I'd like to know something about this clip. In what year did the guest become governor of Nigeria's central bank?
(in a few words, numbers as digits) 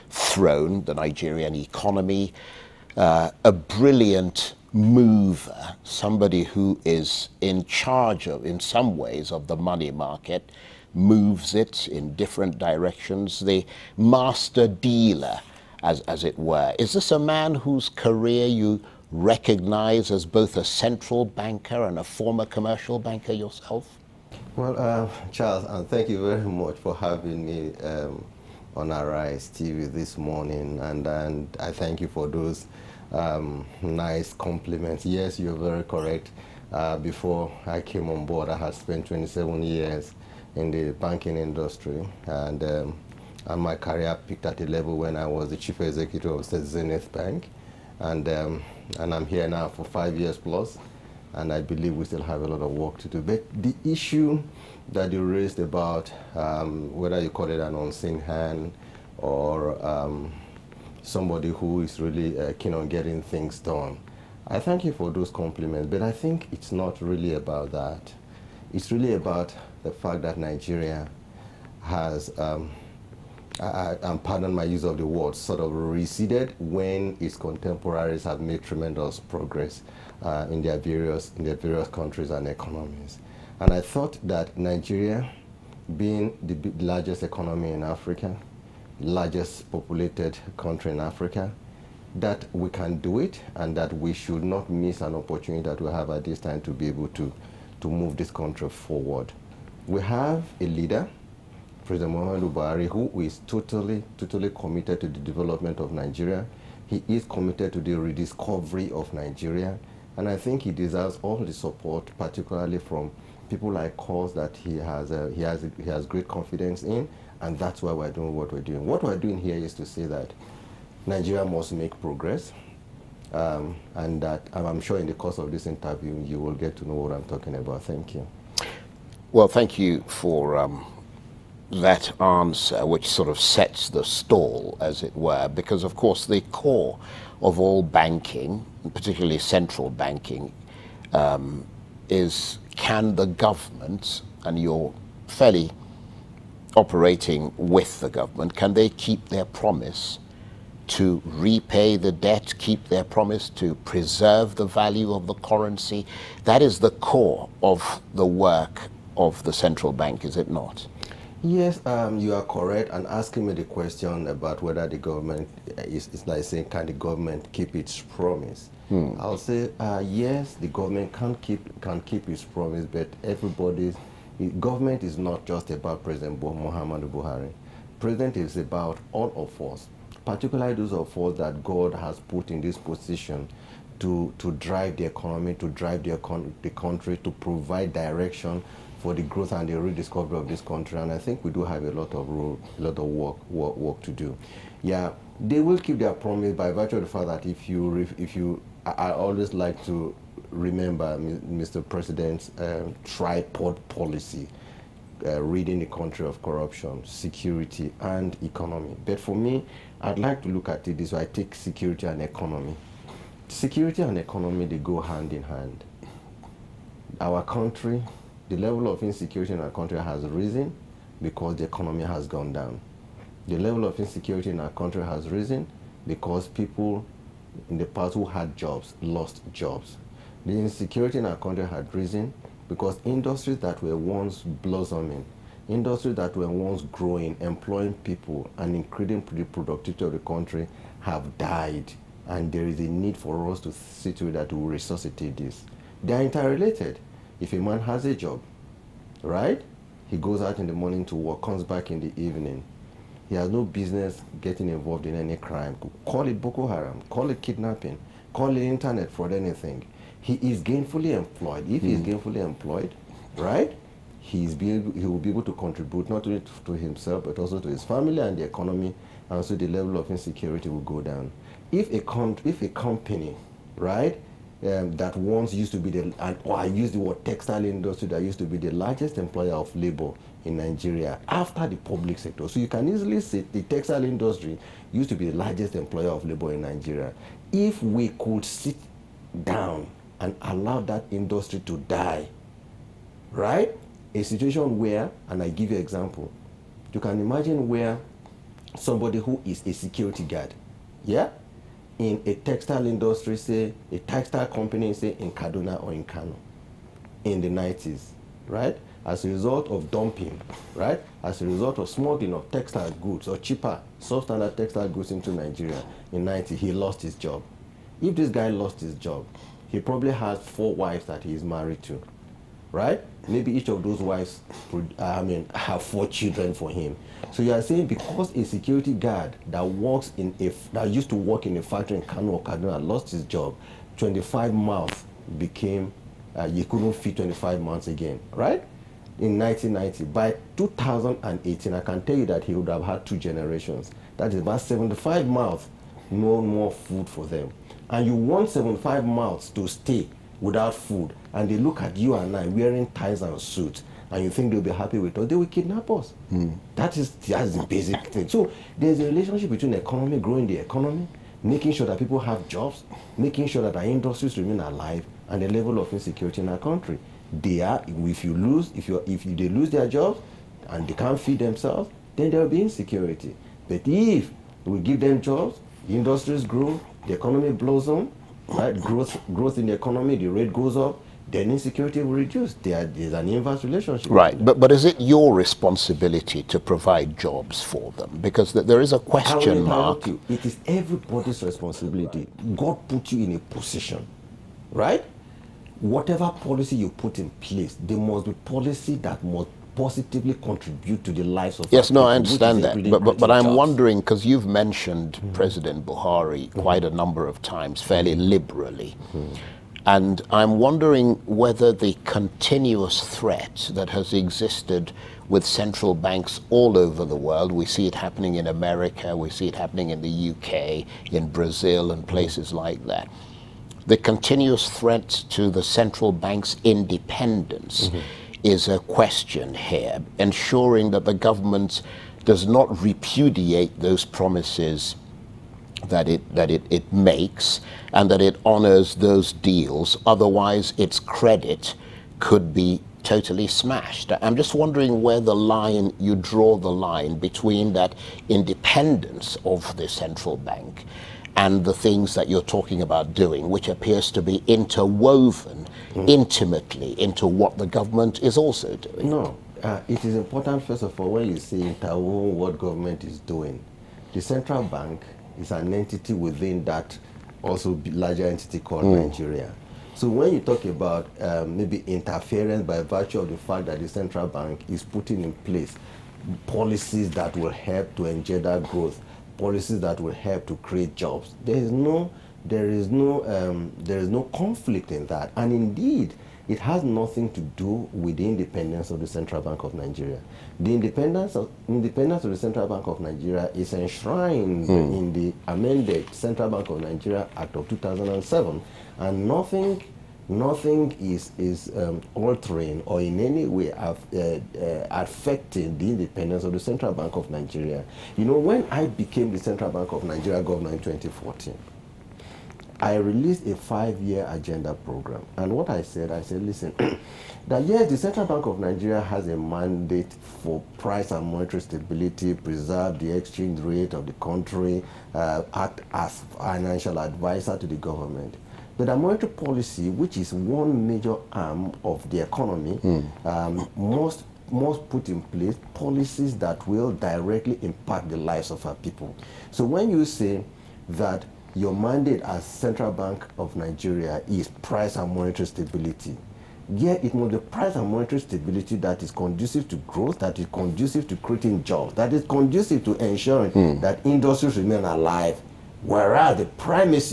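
2014.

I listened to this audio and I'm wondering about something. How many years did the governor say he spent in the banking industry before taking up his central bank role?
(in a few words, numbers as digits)
27.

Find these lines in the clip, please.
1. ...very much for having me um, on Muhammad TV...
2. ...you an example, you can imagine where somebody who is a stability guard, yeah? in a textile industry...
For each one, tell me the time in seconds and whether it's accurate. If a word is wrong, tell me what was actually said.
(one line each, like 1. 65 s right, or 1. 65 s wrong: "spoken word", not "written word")
1. 26 s wrong: "Arise", not "Muhammad"
2. 295 s wrong: "security", not "stability".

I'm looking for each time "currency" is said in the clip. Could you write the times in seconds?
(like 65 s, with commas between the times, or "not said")
155 s.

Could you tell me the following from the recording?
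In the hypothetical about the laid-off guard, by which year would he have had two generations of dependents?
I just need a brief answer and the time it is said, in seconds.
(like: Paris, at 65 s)
2018, at 340 s.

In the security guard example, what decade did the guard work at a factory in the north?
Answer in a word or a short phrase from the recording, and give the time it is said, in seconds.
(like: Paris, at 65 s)
the 90s, at 307 s.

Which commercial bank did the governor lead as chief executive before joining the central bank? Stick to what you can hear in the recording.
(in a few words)
Zenith Bank.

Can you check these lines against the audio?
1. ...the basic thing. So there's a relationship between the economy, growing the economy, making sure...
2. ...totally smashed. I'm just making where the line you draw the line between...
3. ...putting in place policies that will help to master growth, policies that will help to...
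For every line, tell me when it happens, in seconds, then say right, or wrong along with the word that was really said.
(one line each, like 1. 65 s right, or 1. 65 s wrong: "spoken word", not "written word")
1. 357 s right
2. 443 s wrong: "wondering", not "making"
3. 474 s wrong: "engender", not "master".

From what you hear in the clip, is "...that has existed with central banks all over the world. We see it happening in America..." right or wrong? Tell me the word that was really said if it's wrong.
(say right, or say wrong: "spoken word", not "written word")
right.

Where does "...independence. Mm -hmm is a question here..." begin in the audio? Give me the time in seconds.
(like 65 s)
426 s.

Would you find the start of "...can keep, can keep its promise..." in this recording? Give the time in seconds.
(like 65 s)
171 s.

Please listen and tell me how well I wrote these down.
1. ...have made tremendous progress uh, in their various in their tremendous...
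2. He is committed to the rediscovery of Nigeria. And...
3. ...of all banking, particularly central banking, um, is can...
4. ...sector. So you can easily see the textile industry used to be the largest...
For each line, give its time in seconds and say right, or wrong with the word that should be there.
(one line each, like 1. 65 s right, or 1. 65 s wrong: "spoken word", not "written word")
1. 78 s wrong: "various", not "tremendous"
2. 106 s right
3. 137 s right
4. 282 s right.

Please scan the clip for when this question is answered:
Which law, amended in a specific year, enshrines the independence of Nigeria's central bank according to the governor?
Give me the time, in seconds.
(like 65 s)
496 s.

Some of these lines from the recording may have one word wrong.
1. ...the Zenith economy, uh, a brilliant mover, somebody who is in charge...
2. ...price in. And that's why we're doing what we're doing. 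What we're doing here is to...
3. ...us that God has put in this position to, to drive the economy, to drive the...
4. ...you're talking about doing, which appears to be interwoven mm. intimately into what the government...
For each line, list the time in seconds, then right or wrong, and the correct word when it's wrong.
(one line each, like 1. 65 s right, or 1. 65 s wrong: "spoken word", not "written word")
1. 0 s wrong: "Nigerian", not "Zenith"
2. 116 s wrong: "confidence", not "price"
3. 181 s right
4. 452 s right.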